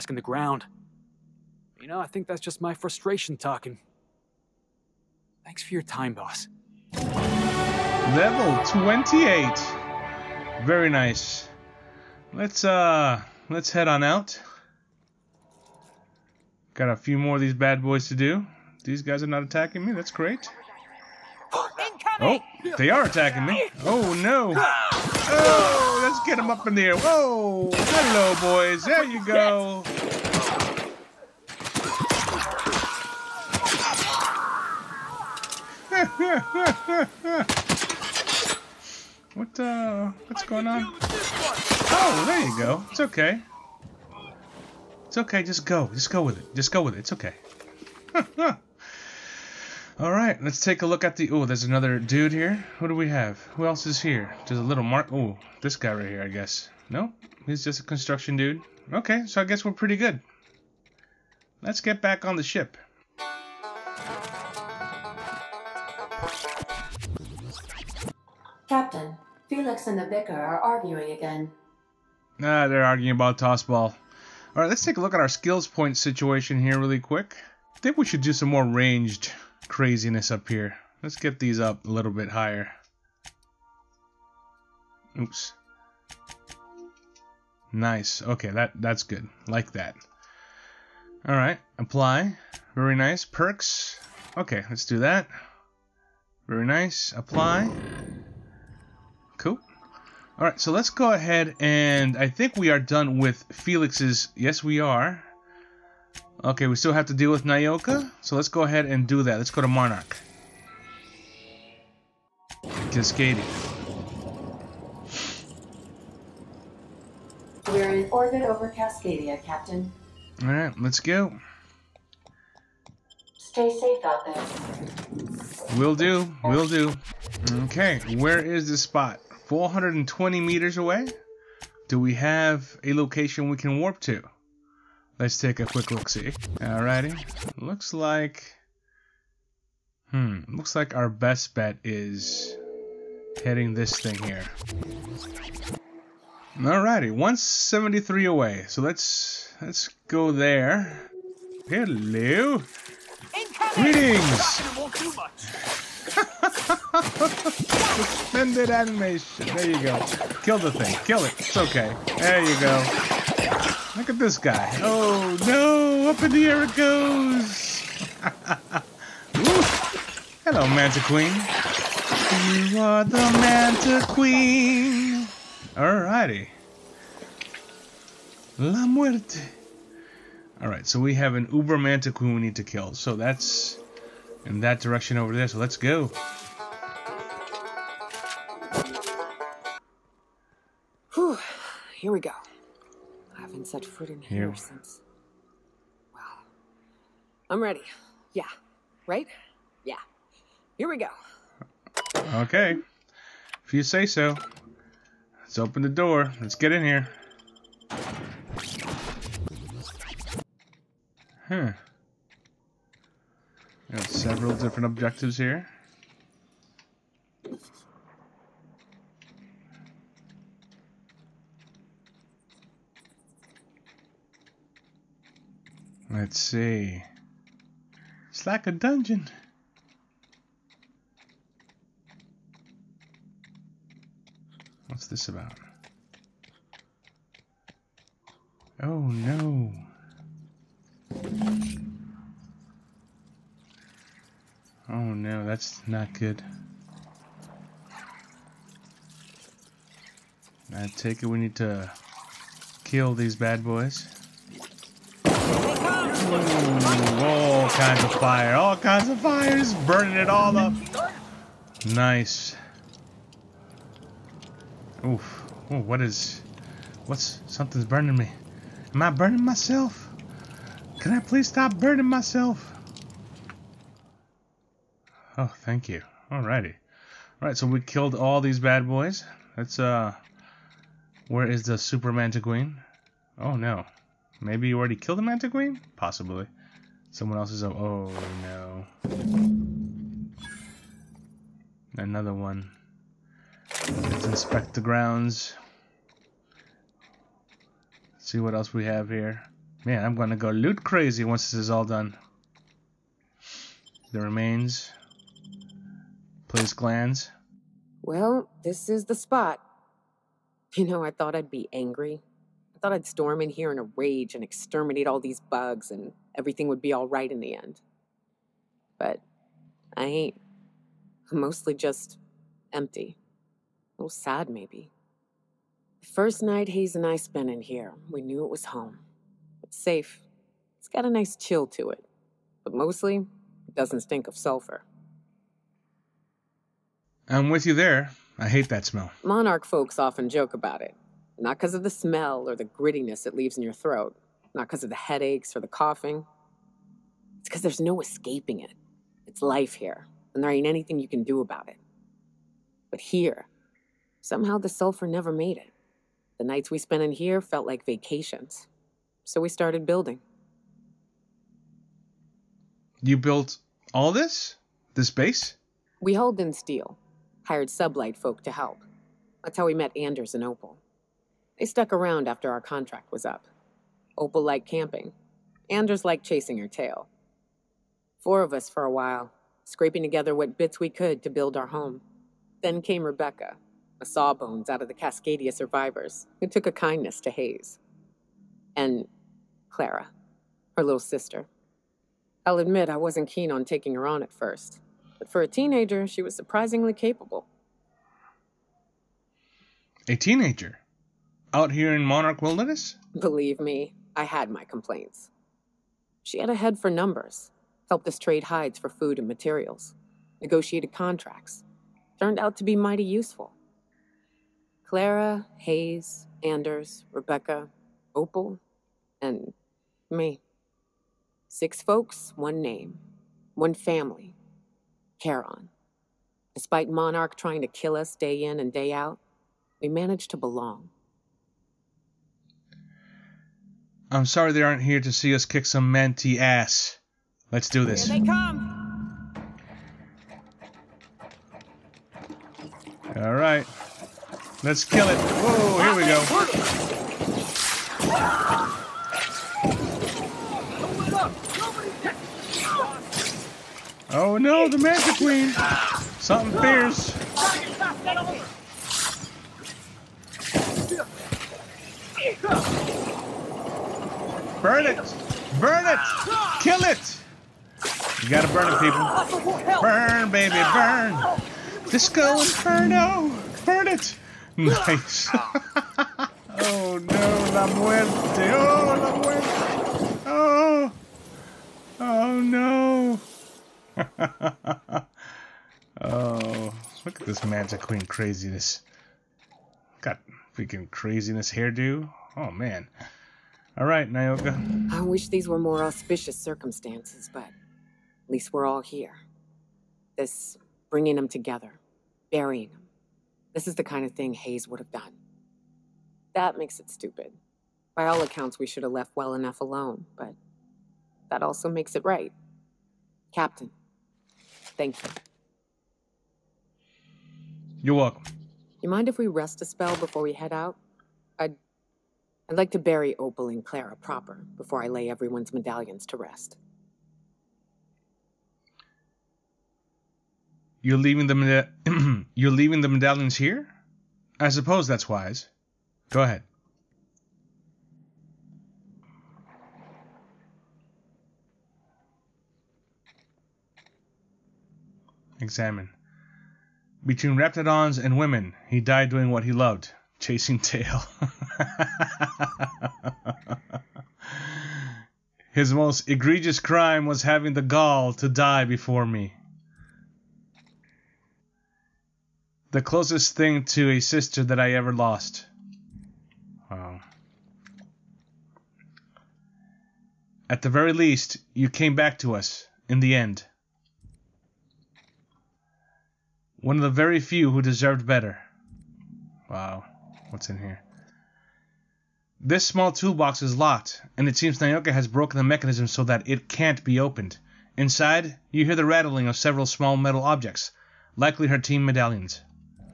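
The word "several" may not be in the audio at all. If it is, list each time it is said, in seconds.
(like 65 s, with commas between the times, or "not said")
214 s, 589 s.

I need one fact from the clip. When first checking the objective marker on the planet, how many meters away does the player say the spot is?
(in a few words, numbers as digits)
420.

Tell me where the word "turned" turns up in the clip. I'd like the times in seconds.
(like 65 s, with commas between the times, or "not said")
412 s.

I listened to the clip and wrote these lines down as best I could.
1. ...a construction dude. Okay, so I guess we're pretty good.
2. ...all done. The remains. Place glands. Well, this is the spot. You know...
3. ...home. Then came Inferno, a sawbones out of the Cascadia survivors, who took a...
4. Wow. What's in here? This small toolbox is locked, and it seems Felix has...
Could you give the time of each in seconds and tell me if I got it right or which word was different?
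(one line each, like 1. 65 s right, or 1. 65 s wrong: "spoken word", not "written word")
1. 57 s right
2. 301 s right
3. 381 s wrong: "Rebecca", not "Inferno"
4. 579 s wrong: "Nyoka", not "Felix".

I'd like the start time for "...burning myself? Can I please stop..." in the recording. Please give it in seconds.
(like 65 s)
269 s.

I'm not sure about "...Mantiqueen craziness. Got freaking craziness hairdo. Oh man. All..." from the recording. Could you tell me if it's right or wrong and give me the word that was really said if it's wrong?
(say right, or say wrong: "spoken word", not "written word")
right.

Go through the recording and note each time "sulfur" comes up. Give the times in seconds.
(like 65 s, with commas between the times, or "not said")
334 s, 354 s.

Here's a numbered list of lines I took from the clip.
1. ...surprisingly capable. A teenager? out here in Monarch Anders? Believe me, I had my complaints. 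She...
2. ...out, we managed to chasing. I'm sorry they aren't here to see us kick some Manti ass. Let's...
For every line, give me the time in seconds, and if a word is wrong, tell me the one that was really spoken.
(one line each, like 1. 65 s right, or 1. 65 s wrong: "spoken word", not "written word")
1. 396 s wrong: "Wilderness", not "Anders"
2. 428 s wrong: "belong", not "chasing".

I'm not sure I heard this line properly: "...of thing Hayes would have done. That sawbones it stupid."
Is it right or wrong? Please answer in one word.
wrong.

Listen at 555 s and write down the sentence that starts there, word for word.
His most egregious crime was having the gall to die before me.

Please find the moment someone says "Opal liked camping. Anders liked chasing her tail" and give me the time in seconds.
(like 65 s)
374 s.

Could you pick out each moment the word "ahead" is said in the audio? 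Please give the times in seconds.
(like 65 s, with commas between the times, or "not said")
101 s, 108 s, 536 s.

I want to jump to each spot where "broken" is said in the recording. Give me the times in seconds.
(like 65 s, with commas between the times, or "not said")
585 s.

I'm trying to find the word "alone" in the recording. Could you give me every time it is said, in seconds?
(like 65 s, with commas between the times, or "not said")
509 s.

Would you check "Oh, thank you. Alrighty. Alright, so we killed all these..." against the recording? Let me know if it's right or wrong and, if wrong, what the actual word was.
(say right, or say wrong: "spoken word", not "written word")
right.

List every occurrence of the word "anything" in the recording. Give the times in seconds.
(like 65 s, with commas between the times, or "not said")
350 s.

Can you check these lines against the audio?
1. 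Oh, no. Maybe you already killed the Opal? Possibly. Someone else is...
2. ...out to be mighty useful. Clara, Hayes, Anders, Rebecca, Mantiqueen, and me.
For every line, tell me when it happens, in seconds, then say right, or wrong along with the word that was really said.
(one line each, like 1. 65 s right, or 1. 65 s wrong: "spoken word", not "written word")
1. 283 s wrong: "Mantiqueen", not "Opal"
2. 412 s wrong: "Opal", not "Mantiqueen".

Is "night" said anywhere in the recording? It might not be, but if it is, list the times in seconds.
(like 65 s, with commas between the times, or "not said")
326 s, 356 s.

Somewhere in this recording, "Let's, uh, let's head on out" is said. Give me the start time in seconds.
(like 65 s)
12 s.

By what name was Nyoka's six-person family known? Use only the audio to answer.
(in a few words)
Charon.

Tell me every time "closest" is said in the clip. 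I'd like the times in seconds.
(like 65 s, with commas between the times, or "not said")
562 s.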